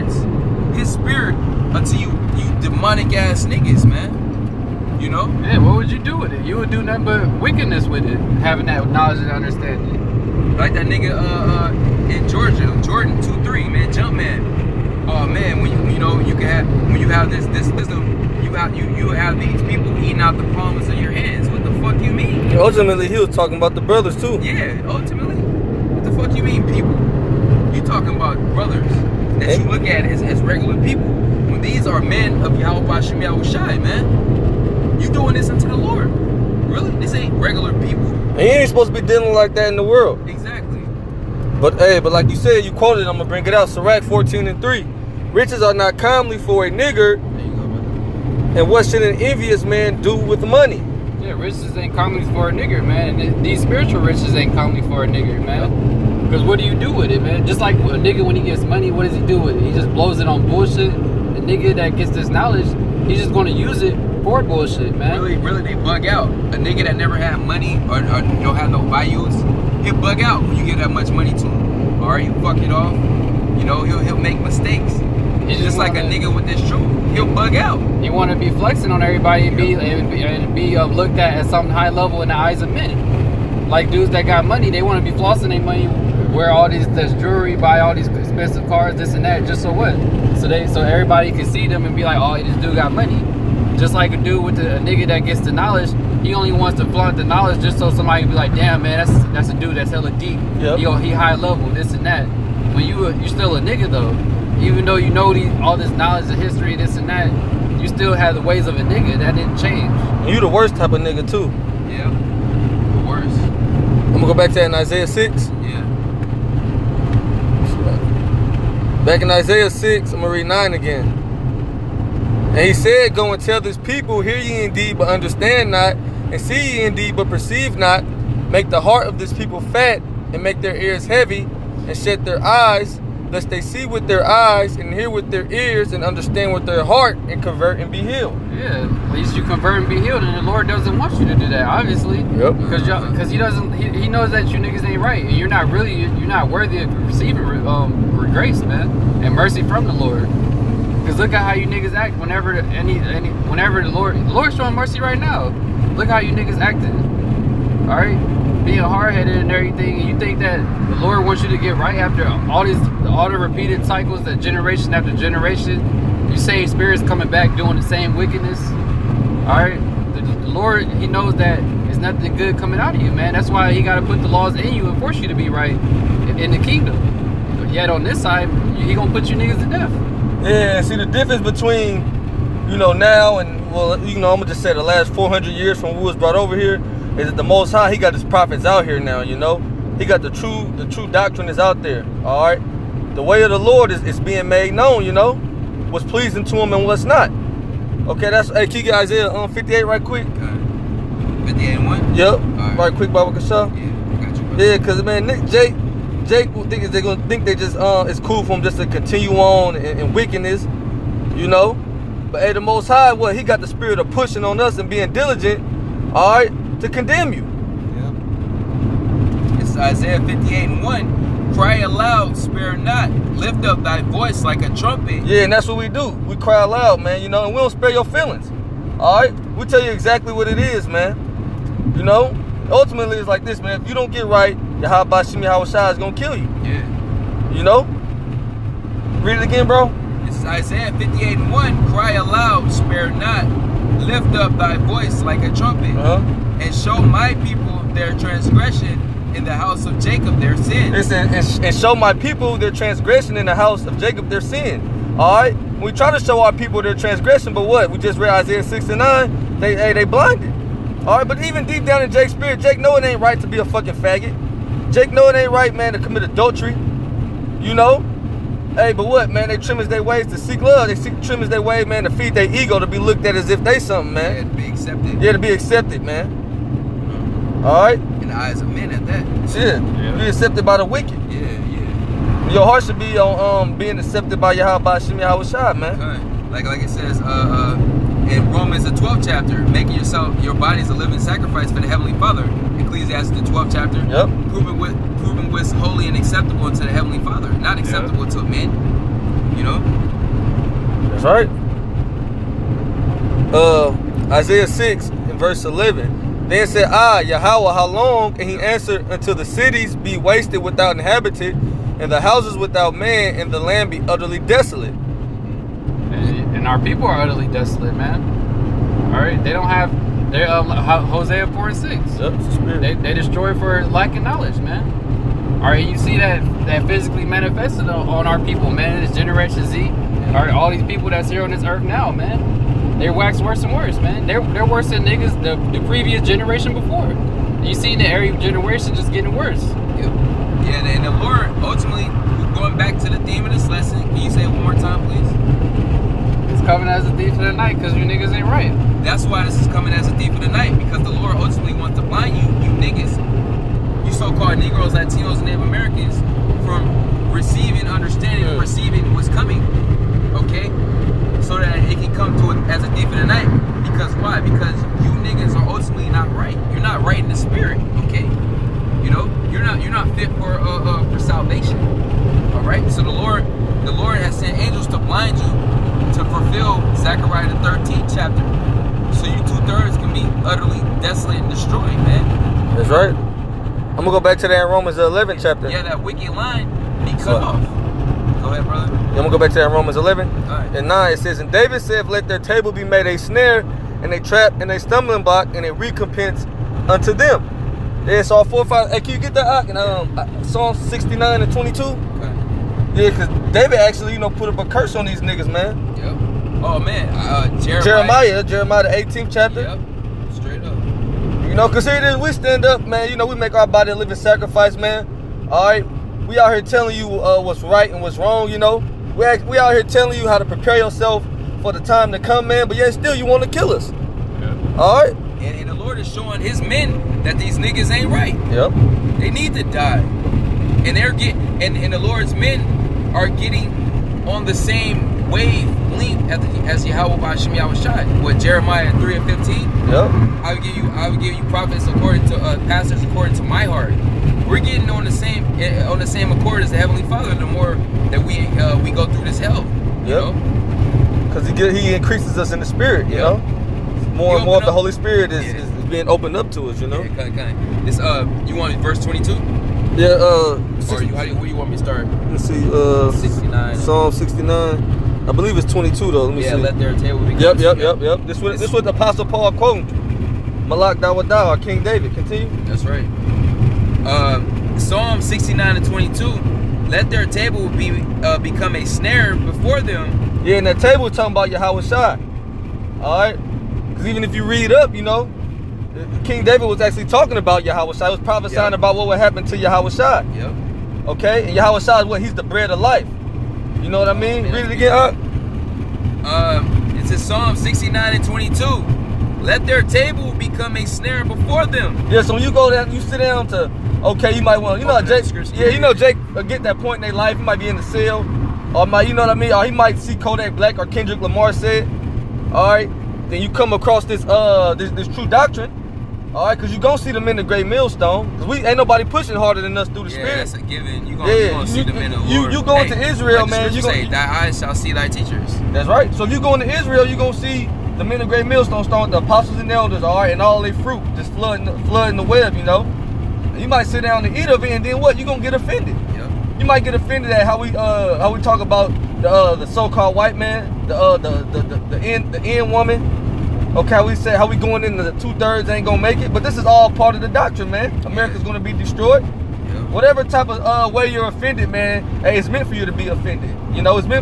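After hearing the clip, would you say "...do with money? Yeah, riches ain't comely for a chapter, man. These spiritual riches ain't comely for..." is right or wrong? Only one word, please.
wrong.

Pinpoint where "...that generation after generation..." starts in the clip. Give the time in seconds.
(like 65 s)
164 s.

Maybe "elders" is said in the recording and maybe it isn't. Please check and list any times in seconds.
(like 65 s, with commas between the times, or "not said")
529 s.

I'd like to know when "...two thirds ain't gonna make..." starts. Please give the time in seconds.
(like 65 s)
545 s.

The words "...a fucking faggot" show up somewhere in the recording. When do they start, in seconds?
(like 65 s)
263 s.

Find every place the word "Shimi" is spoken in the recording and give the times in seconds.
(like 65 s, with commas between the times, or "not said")
235 s, 284 s.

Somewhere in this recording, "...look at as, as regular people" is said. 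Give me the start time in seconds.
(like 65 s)
29 s.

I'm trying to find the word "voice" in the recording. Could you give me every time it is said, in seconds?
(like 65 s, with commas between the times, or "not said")
224 s, 244 s.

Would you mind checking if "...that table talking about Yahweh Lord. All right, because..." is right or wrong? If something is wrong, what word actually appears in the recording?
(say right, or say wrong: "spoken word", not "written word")
wrong: "Shai", not "Lord".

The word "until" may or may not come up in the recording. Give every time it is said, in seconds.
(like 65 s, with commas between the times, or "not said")
1 s, 309 s.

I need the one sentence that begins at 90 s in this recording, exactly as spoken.
So they so everybody can see them and be like, oh, this dude got money.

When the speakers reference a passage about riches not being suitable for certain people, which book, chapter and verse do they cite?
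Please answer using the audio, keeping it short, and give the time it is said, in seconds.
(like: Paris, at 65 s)
Sirach 14:3, at 43 s.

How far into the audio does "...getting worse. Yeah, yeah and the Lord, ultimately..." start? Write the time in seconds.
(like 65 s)
339 s.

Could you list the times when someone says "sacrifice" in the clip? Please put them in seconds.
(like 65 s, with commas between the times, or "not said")
291 s, 414 s.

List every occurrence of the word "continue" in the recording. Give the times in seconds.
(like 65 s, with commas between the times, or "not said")
208 s, 472 s.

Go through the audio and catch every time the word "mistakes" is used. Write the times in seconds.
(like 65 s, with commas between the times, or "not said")
74 s.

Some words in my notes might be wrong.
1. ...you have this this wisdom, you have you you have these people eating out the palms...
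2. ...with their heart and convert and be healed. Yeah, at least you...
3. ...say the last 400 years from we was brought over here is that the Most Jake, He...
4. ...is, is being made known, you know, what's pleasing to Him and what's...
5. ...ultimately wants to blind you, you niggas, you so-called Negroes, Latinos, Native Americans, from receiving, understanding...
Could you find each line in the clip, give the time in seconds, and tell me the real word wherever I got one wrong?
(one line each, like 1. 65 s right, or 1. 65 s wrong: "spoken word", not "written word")
1. 17 s right
2. 136 s right
3. 184 s wrong: "High", not "Jake"
4. 193 s right
5. 351 s right.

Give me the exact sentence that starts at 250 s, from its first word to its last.
Listen, and, and show my people their transgression in the house of Jacob their sin.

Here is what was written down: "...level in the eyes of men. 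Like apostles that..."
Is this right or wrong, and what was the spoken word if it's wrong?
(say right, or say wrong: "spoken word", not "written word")
wrong: "dudes", not "apostles".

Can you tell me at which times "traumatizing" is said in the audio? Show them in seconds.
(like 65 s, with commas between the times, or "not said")
not said.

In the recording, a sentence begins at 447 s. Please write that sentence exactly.
The more that we uh, we go through this hell, you yep.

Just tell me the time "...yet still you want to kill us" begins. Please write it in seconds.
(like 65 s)
422 s.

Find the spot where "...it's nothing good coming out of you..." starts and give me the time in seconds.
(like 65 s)
171 s.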